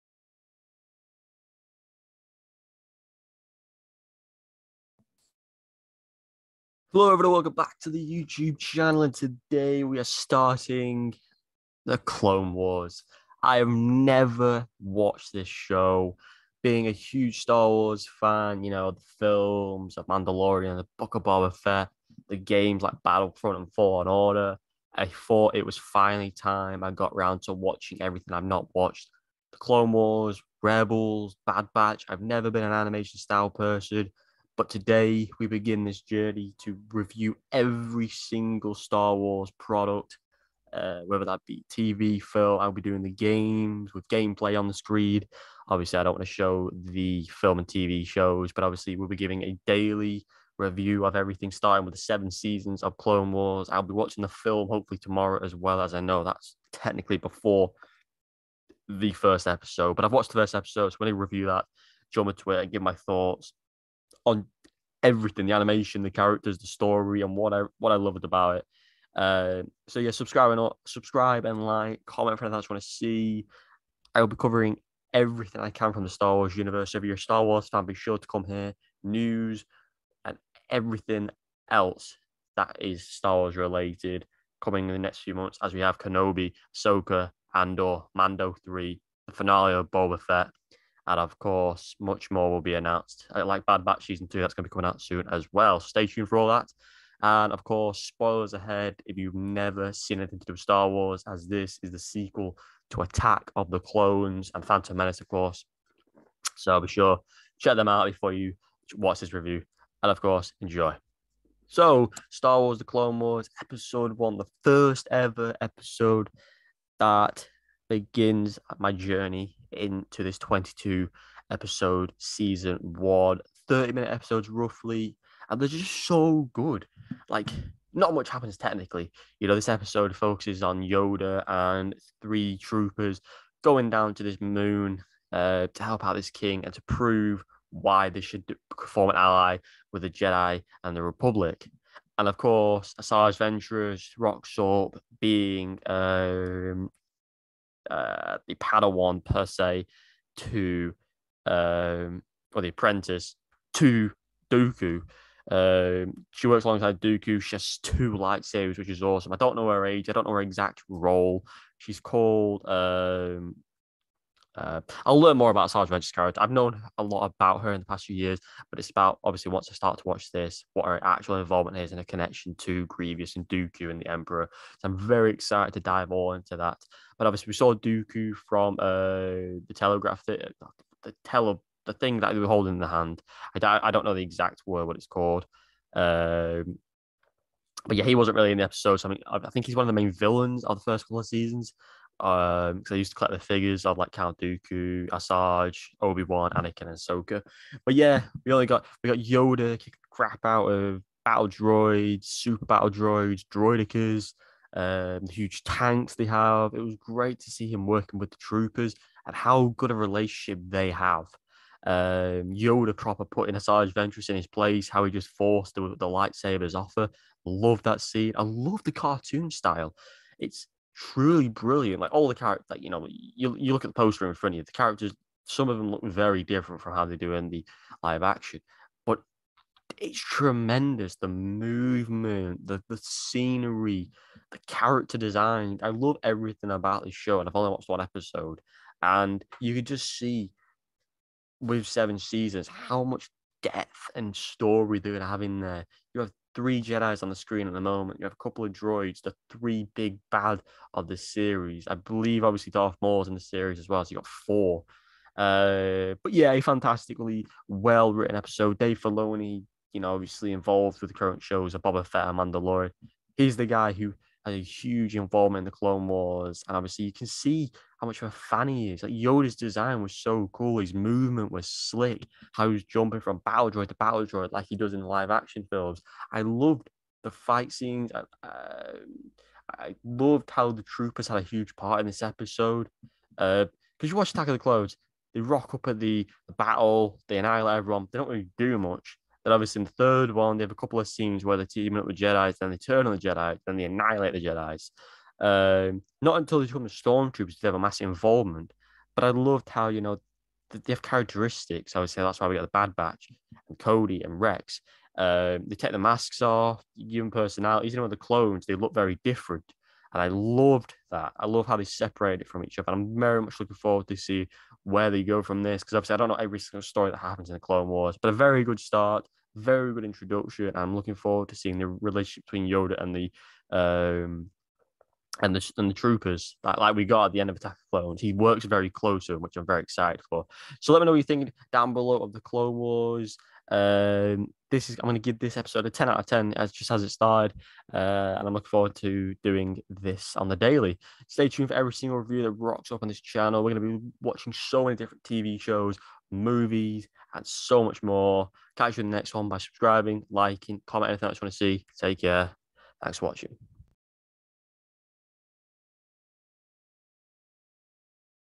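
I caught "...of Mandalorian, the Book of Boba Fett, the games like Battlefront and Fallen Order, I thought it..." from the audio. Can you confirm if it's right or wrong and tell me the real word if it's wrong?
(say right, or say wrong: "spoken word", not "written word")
right.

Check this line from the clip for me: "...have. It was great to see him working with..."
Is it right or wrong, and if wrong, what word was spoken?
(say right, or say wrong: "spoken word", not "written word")
right.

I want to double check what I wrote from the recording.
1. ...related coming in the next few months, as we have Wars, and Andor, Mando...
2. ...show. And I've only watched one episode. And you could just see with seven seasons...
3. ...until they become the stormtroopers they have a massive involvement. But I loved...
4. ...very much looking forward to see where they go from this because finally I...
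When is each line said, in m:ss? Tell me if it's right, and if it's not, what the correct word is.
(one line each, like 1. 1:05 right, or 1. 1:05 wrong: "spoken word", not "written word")
1. 1:23 wrong: "Kenobi", not "Wars"
2. 3:57 right
3. 4:56 right
4. 5:13 wrong: "obviously", not "finally".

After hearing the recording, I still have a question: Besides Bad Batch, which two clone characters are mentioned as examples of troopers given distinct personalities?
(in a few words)
Cody and Rex.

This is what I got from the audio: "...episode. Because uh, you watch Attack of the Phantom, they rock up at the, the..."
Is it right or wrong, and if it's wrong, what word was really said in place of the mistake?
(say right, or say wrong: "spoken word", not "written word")
wrong: "Clones", not "Phantom".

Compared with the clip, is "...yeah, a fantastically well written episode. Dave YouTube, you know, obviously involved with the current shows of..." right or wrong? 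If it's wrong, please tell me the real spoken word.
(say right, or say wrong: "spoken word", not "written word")
wrong: "Filoni", not "YouTube".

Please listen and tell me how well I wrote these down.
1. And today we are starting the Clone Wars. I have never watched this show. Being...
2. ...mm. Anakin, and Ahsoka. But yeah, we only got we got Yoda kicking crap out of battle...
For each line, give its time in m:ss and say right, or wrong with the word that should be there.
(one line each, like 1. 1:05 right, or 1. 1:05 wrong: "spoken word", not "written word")
1. 0:09 right
2. 3:16 right.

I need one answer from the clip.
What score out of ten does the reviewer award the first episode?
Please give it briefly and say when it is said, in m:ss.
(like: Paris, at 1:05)
10, at 5:35.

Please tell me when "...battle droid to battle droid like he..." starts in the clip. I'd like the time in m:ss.
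4:33.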